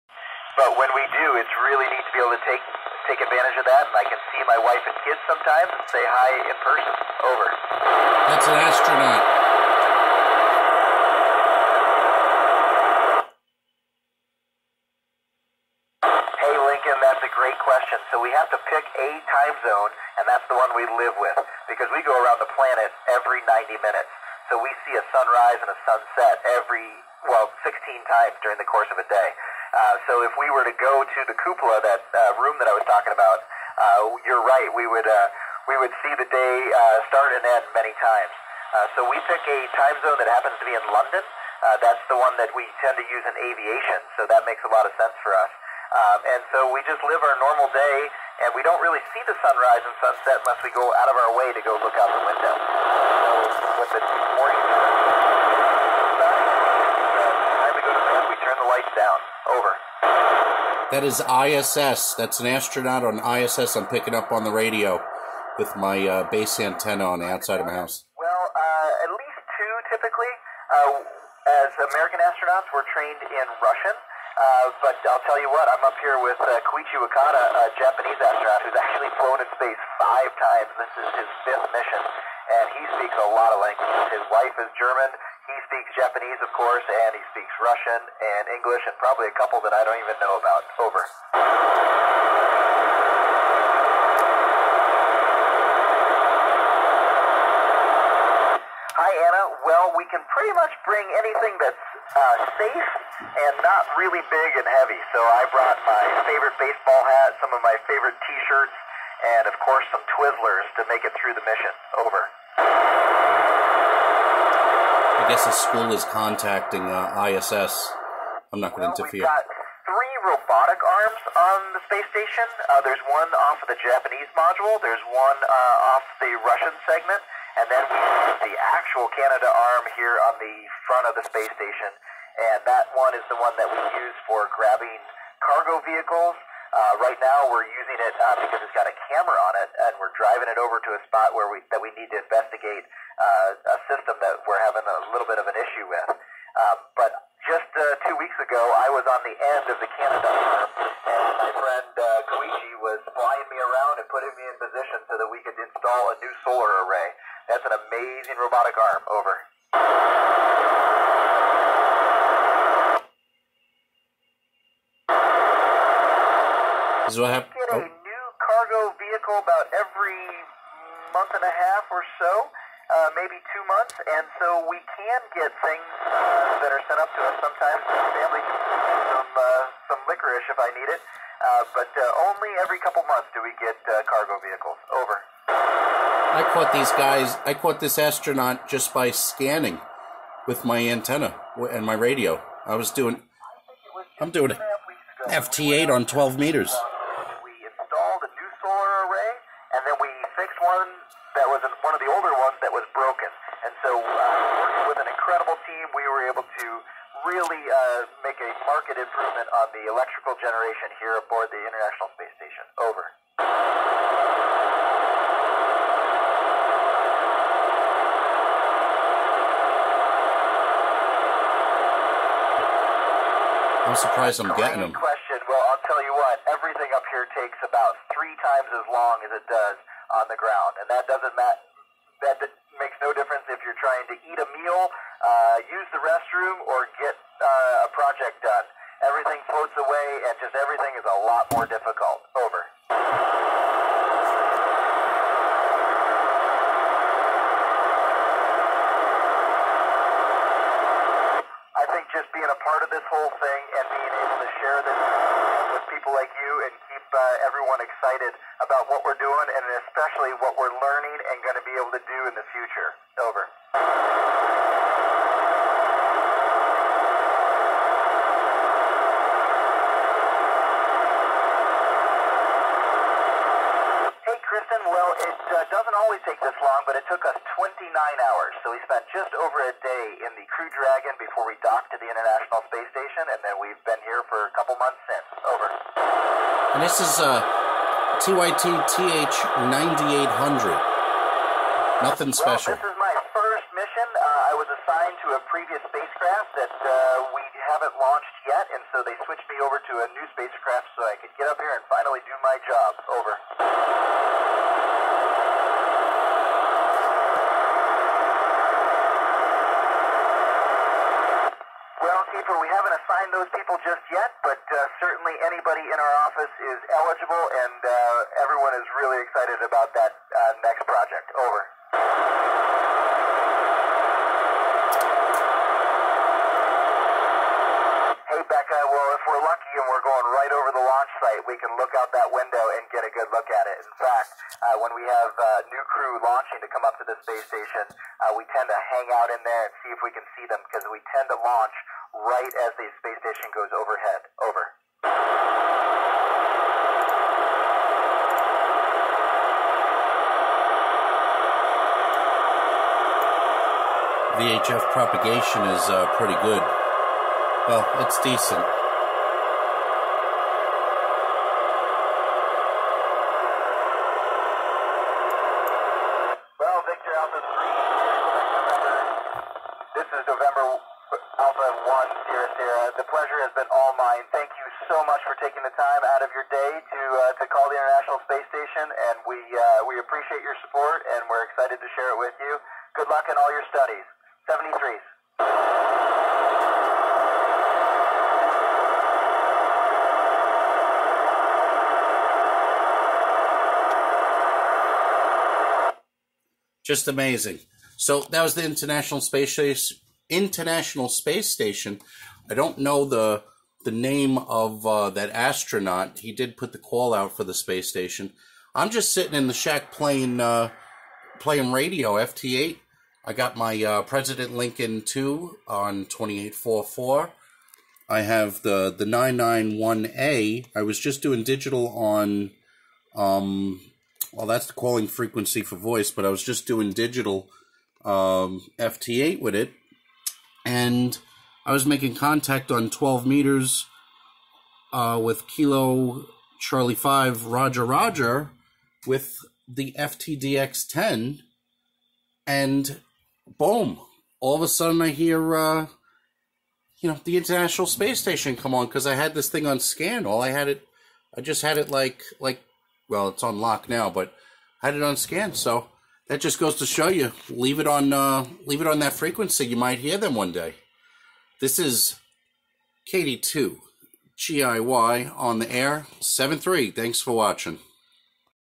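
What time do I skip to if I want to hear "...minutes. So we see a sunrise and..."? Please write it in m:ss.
0:23.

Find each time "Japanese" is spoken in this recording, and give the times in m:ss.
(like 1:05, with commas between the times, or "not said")
1:17, 1:25, 2:03.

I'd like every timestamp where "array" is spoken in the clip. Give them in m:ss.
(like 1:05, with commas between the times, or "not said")
2:36, 3:19.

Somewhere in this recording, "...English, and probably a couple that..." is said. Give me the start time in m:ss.
1:28.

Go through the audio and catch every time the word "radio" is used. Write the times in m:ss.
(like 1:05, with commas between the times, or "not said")
1:04, 3:11, 6:51.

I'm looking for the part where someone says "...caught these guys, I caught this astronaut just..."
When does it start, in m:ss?
3:06.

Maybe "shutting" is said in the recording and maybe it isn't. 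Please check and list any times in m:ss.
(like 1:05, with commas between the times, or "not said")
not said.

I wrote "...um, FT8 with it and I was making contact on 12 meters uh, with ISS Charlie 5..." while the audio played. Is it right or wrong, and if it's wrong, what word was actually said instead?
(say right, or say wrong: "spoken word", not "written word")
wrong: "Kilo", not "ISS".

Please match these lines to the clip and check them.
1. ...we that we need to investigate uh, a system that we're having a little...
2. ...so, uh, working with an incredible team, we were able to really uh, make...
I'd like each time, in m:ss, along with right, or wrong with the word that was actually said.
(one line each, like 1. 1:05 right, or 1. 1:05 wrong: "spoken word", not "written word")
1. 2:21 right
2. 3:23 right.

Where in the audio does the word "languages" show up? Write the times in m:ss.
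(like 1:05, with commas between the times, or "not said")
1:23.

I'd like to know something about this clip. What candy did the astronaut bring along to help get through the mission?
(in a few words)
Twizzlers.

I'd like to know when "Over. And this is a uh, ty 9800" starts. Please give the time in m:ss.
4:45.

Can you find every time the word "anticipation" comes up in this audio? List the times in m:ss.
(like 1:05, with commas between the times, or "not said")
not said.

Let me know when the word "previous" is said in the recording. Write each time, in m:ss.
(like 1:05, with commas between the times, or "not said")
4:55.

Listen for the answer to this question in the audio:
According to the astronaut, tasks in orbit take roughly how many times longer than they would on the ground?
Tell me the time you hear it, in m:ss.
3:48.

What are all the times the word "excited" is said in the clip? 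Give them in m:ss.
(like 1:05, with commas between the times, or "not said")
4:17, 5:19, 6:21.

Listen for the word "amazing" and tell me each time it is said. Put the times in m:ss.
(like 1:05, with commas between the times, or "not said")
2:37, 6:37.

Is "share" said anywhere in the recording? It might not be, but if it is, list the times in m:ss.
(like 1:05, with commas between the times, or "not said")
4:14, 6:21.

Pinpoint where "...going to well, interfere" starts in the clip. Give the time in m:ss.
1:58.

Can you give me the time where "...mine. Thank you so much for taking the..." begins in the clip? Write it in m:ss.
6:13.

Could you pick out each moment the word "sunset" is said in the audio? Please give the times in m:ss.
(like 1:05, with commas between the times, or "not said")
0:25, 0:50.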